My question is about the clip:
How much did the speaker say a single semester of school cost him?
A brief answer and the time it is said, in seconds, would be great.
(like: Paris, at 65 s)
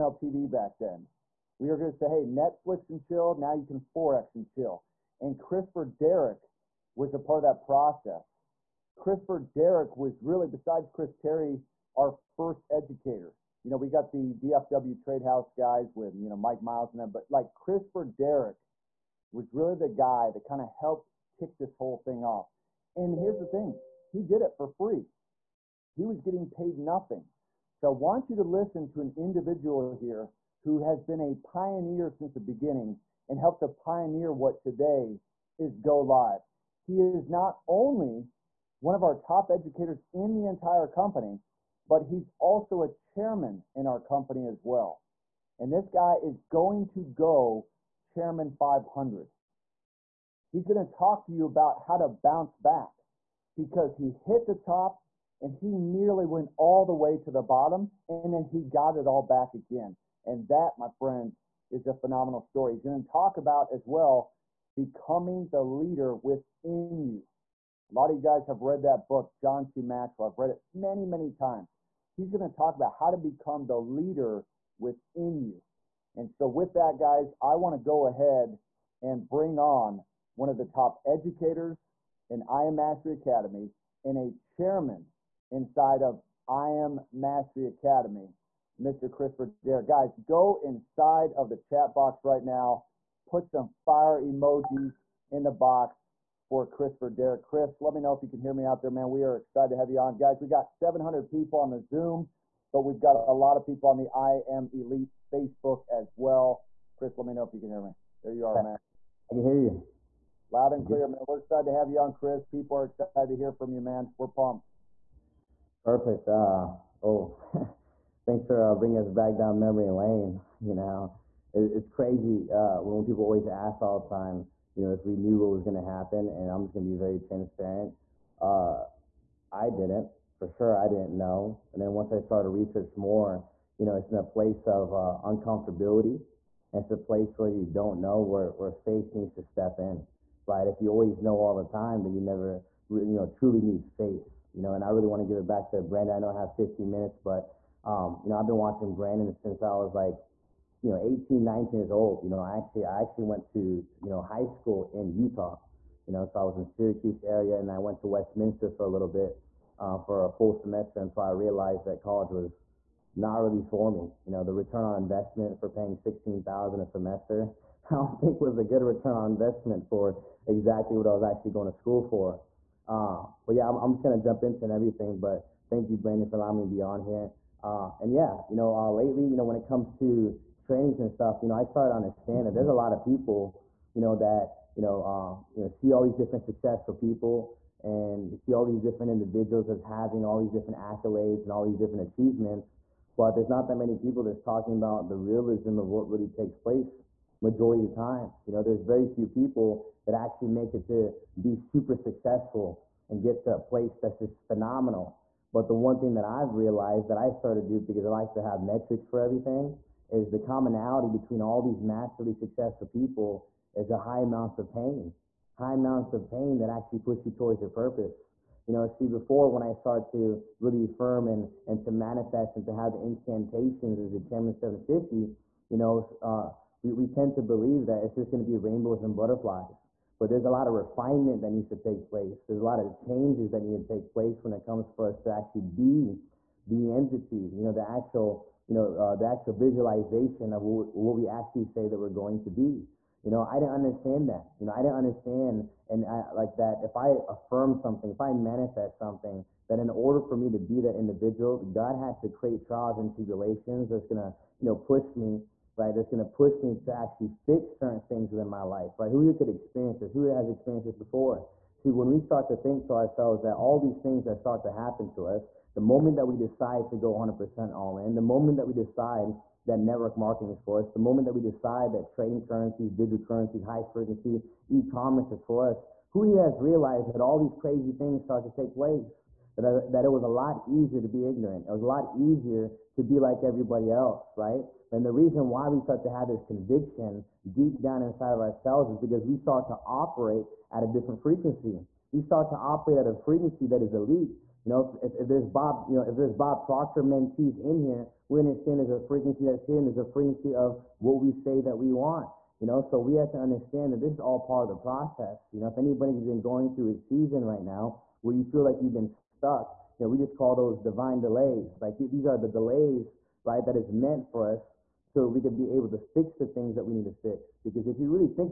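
$16,000, at 165 s.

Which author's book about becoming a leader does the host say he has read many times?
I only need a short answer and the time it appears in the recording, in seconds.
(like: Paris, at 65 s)
John C. Maxwell, at 69 s.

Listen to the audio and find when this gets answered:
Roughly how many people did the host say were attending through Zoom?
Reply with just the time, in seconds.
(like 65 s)
100 s.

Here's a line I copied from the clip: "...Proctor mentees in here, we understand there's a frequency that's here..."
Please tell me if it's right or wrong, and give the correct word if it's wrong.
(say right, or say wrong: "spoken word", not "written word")
right.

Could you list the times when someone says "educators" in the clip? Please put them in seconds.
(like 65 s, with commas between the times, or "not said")
12 s, 39 s, 81 s.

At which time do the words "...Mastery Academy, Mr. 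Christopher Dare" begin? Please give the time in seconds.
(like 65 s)
87 s.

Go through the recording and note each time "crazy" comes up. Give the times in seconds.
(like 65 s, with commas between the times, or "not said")
121 s, 277 s.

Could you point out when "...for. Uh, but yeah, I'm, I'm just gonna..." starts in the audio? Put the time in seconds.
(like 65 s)
172 s.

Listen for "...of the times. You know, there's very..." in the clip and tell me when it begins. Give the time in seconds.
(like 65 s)
197 s.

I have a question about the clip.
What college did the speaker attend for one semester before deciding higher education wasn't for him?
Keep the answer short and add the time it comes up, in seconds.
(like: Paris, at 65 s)
Westminster, at 158 s.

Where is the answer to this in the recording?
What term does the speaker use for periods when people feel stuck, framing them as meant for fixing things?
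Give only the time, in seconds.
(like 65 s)
310 s.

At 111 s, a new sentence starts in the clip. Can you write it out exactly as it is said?
We're excited to have you on, Chris.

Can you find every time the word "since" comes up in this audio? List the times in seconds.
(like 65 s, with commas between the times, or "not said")
32 s, 149 s.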